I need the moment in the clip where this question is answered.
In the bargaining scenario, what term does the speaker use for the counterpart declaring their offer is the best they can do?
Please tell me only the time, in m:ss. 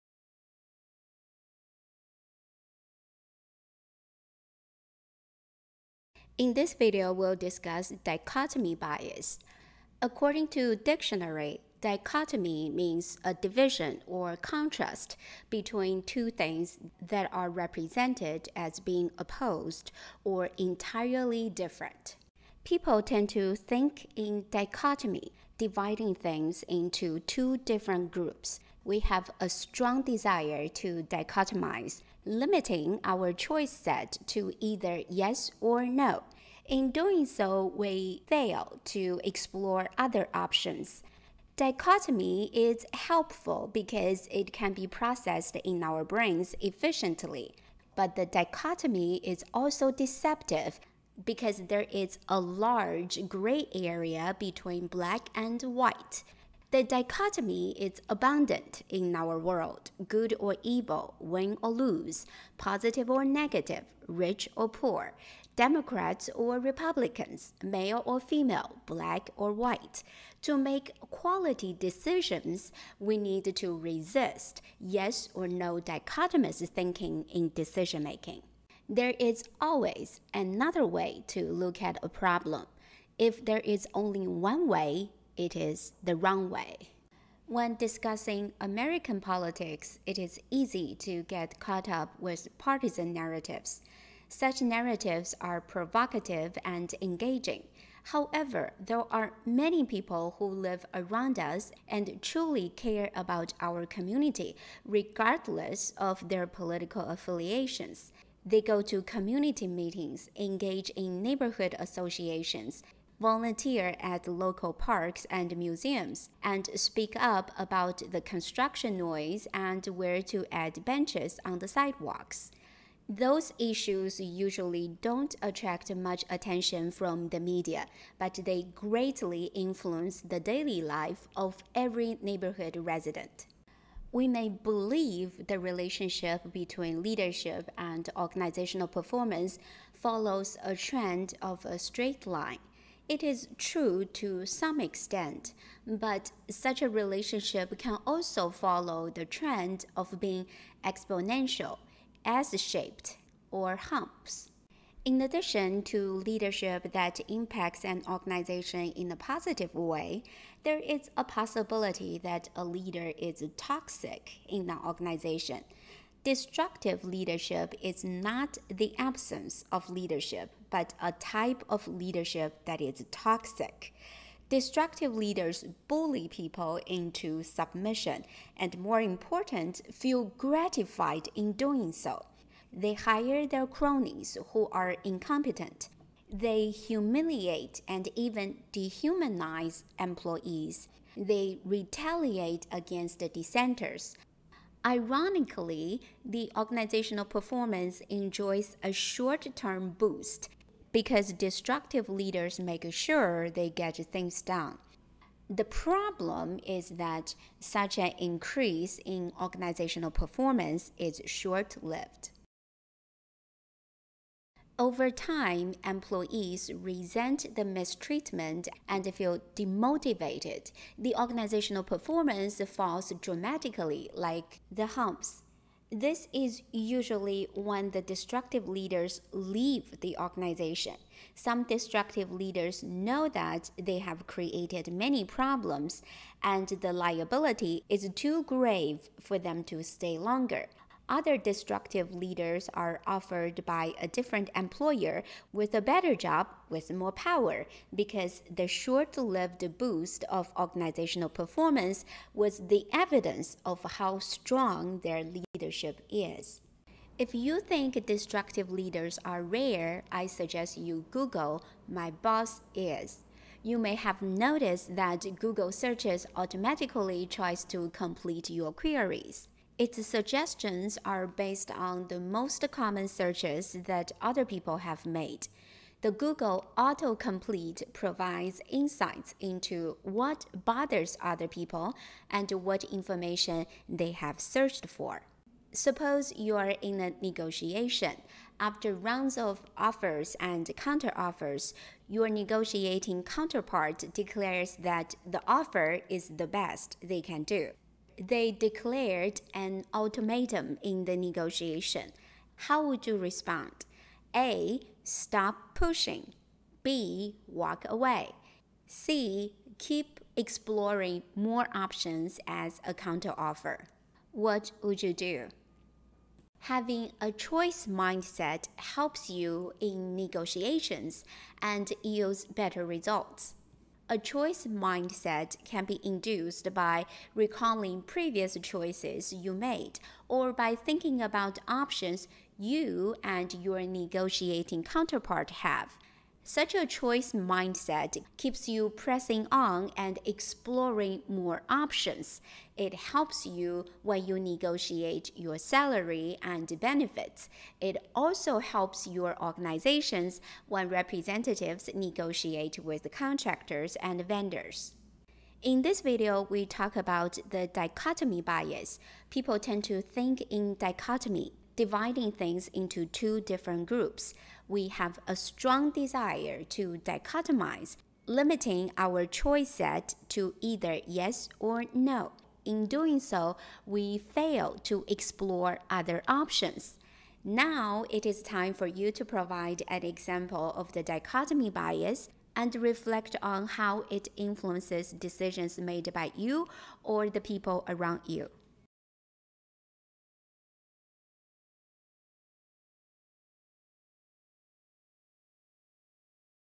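4:59.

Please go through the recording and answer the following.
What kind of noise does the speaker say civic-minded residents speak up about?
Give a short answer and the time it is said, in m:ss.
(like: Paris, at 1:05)
Construction noise, at 1:58.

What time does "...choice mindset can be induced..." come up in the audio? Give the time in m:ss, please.
5:24.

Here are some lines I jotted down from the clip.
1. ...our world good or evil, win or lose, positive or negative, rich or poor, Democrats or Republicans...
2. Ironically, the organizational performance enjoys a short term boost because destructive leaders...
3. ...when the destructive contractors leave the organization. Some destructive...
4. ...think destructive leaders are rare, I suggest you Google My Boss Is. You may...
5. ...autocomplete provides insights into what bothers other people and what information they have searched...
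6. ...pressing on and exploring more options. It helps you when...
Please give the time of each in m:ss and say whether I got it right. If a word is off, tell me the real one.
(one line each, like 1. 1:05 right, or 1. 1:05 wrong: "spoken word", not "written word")
1. 0:59 right
2. 3:14 right
3. 3:47 wrong: "leaders", not "contractors"
4. 4:17 right
5. 4:36 right
6. 5:38 right.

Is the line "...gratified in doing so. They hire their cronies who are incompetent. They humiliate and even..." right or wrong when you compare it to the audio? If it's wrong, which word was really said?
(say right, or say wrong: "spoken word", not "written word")
right.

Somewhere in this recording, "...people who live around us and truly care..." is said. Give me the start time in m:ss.
1:39.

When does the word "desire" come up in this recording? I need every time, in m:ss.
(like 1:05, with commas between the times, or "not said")
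0:30, 6:05.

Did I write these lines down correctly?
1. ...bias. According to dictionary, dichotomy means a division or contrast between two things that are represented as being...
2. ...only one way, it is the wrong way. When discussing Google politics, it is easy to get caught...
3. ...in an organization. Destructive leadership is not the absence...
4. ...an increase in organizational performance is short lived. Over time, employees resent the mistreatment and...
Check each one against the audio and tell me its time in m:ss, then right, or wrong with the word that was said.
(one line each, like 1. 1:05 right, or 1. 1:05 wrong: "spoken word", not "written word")
1. 0:08 right
2. 1:23 wrong: "American", not "Google"
3. 2:44 right
4. 3:27 right.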